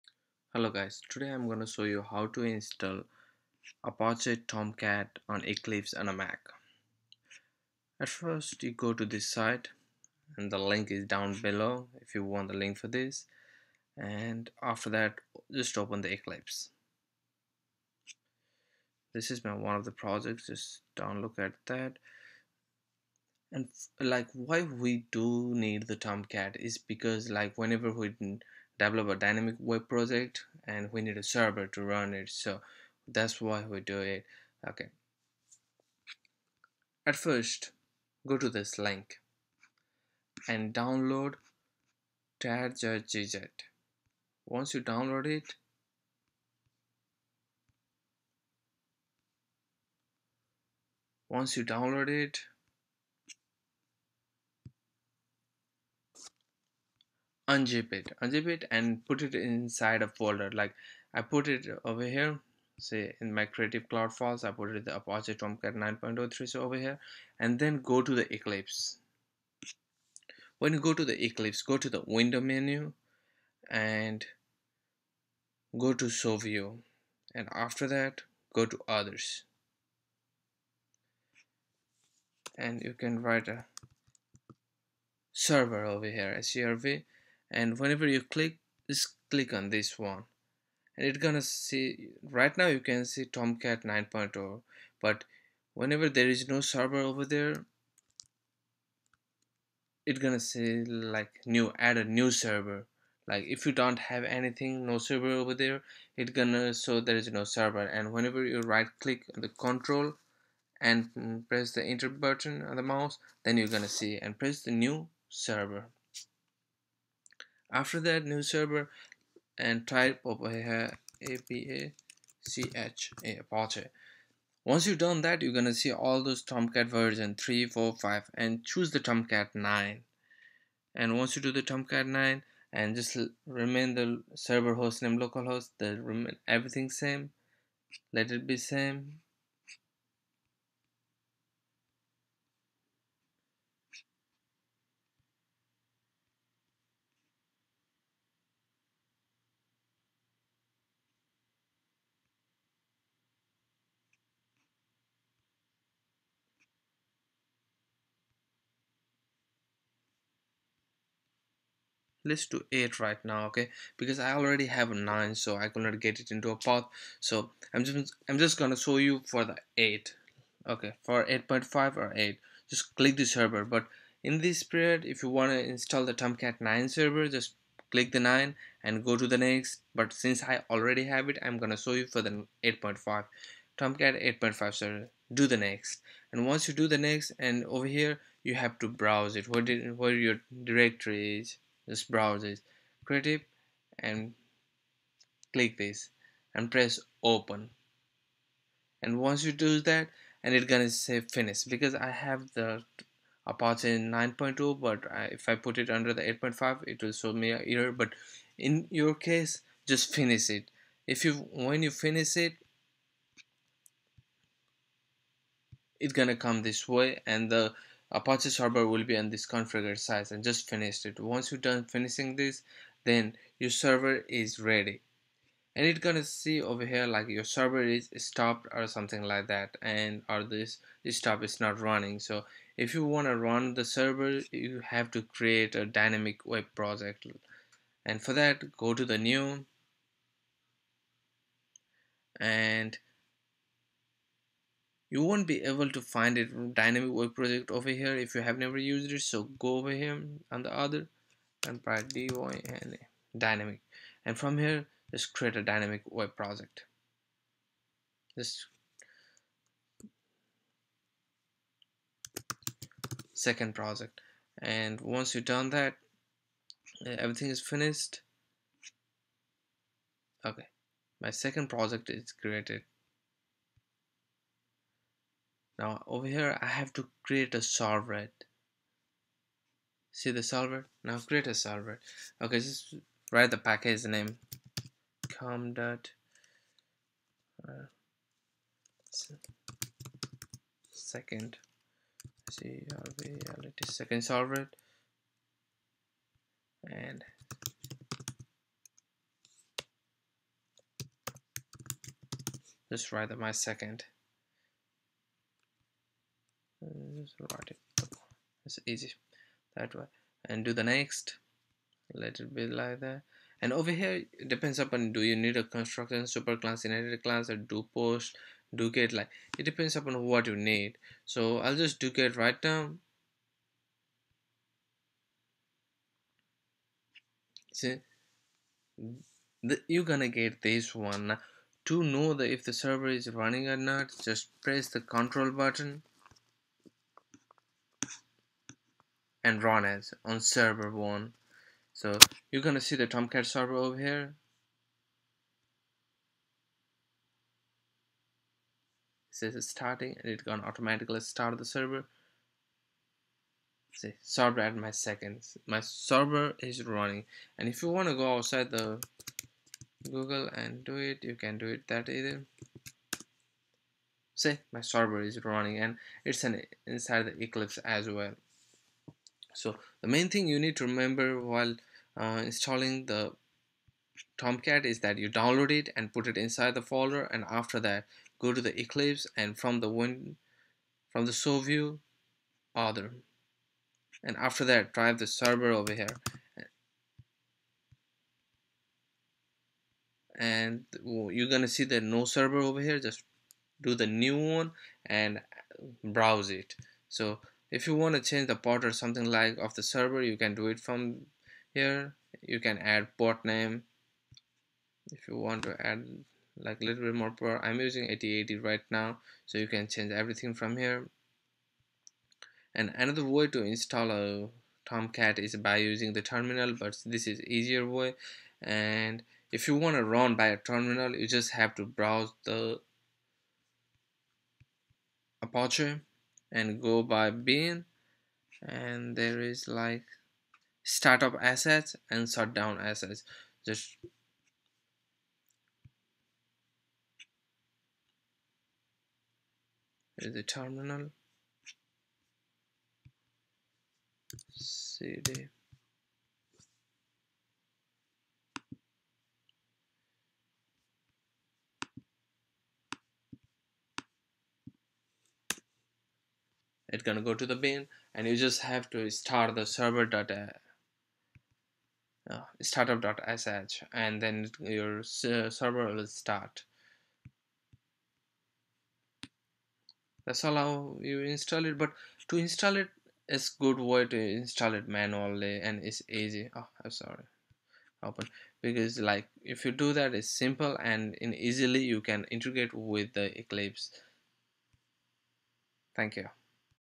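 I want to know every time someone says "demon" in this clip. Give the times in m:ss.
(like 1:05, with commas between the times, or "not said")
not said.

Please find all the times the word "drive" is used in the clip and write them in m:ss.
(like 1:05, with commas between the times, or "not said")
6:24.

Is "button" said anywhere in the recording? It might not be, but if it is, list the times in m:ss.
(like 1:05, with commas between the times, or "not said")
1:52, 5:35.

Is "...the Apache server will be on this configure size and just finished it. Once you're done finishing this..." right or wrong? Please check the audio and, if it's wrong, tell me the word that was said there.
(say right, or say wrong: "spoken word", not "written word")
right.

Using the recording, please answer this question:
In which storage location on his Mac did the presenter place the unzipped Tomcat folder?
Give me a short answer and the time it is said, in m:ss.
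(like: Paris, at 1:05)
Creative Cloud Files, at 1:03.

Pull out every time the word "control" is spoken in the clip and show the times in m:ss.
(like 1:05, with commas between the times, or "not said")
1:49, 5:35.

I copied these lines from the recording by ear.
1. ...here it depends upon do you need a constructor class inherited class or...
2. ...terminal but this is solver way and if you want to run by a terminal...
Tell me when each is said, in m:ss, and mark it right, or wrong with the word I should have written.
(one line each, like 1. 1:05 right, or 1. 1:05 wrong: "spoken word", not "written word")
1. 5:13 wrong: "superclass", not "class"
2. 6:56 wrong: "easier", not "solver".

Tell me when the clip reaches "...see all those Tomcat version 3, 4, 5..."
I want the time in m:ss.
2:05.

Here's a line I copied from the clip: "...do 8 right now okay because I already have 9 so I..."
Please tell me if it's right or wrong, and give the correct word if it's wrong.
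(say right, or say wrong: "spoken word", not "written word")
right.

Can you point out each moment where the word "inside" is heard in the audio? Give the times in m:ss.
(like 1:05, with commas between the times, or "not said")
0:59, 6:06, 6:16.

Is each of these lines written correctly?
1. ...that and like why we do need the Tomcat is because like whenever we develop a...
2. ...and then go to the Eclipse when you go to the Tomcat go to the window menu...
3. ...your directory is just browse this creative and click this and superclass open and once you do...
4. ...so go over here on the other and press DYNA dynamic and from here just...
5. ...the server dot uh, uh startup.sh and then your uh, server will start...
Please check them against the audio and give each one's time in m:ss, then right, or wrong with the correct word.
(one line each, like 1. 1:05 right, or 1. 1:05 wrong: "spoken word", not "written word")
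1. 0:21 right
2. 1:07 wrong: "Eclipse", not "Tomcat"
3. 3:10 wrong: "press", not "superclass"
4. 4:09 right
5. 7:39 right.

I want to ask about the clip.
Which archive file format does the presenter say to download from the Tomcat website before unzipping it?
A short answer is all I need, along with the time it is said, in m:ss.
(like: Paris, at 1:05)
tar.gz, at 0:42.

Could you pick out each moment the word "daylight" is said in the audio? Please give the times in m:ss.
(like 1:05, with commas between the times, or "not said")
not said.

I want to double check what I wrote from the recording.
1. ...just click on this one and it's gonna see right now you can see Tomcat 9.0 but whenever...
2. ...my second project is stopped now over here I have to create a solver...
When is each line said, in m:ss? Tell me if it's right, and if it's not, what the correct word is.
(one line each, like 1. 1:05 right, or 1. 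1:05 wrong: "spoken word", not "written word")
1. 1:28 right
2. 4:31 wrong: "created", not "stopped".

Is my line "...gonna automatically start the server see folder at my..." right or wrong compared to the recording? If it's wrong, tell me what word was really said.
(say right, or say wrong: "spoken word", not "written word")
wrong: "server", not "folder".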